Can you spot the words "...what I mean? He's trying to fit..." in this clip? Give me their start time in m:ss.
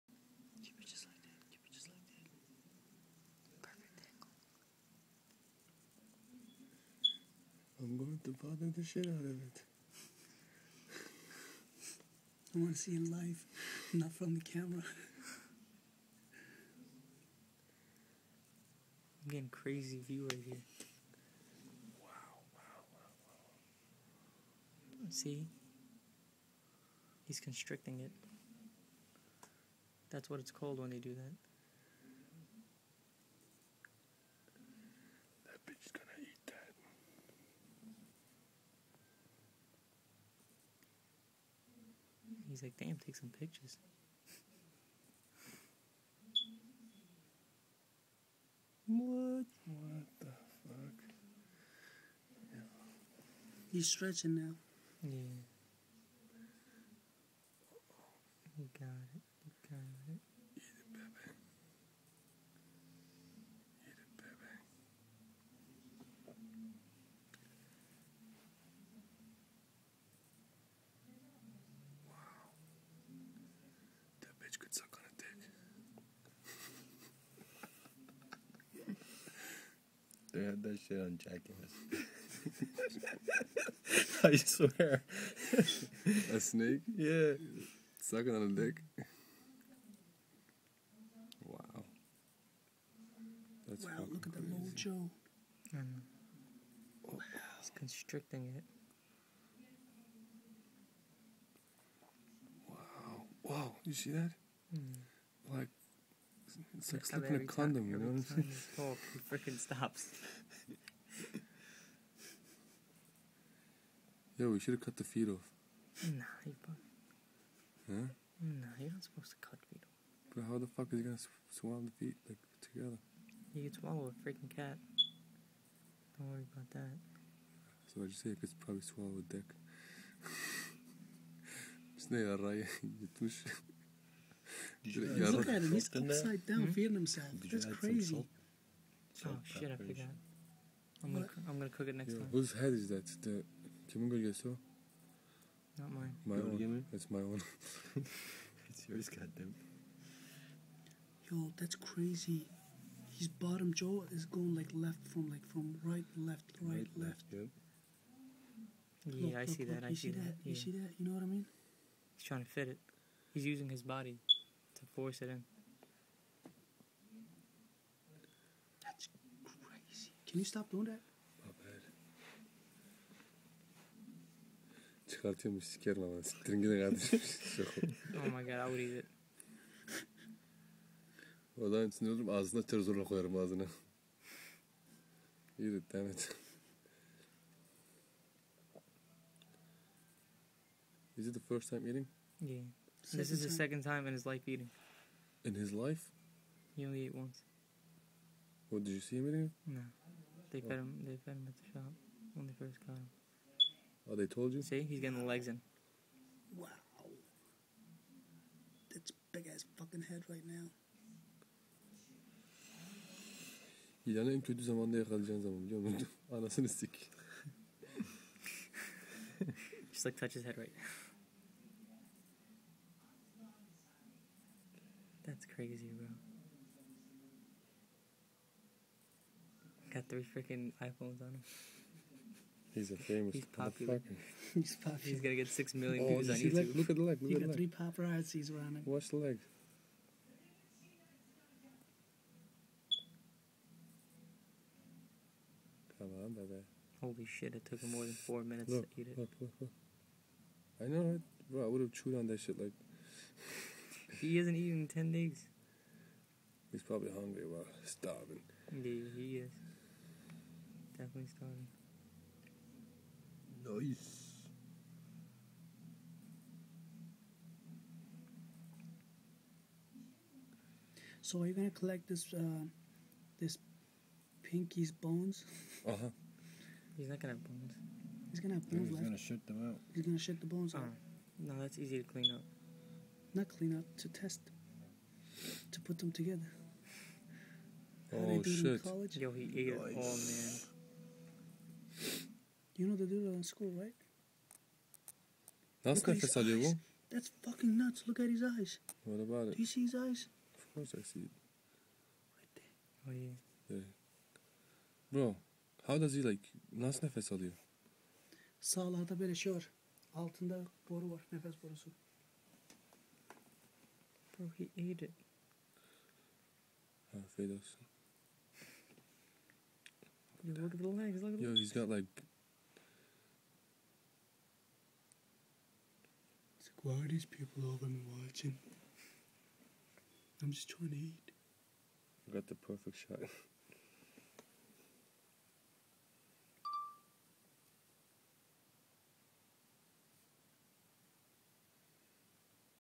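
2:41.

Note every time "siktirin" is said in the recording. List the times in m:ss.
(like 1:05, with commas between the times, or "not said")
2:56.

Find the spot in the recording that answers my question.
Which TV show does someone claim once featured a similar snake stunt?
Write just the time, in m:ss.
1:21.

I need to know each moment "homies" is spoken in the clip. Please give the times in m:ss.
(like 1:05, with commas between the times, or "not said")
not said.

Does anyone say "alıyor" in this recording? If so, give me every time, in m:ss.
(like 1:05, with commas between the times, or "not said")
4:56, 5:07.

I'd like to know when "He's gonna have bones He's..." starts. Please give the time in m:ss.
4:38.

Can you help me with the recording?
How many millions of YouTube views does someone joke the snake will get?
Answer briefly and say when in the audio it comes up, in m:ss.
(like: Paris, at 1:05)
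6 million, at 3:55.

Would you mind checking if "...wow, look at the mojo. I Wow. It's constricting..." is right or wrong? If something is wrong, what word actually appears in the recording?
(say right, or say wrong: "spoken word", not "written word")
right.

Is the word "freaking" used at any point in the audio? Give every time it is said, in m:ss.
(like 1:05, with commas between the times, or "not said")
1:49, 2:04, 3:50.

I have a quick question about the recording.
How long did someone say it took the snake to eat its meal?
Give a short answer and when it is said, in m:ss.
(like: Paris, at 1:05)
more than 4 minutes, at 4:07.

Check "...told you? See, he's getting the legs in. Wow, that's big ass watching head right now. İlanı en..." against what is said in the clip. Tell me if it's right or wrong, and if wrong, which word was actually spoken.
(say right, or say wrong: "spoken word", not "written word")
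wrong: "fucking", not "watching".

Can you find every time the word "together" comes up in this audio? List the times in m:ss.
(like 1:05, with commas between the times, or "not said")
2:02, 4:46.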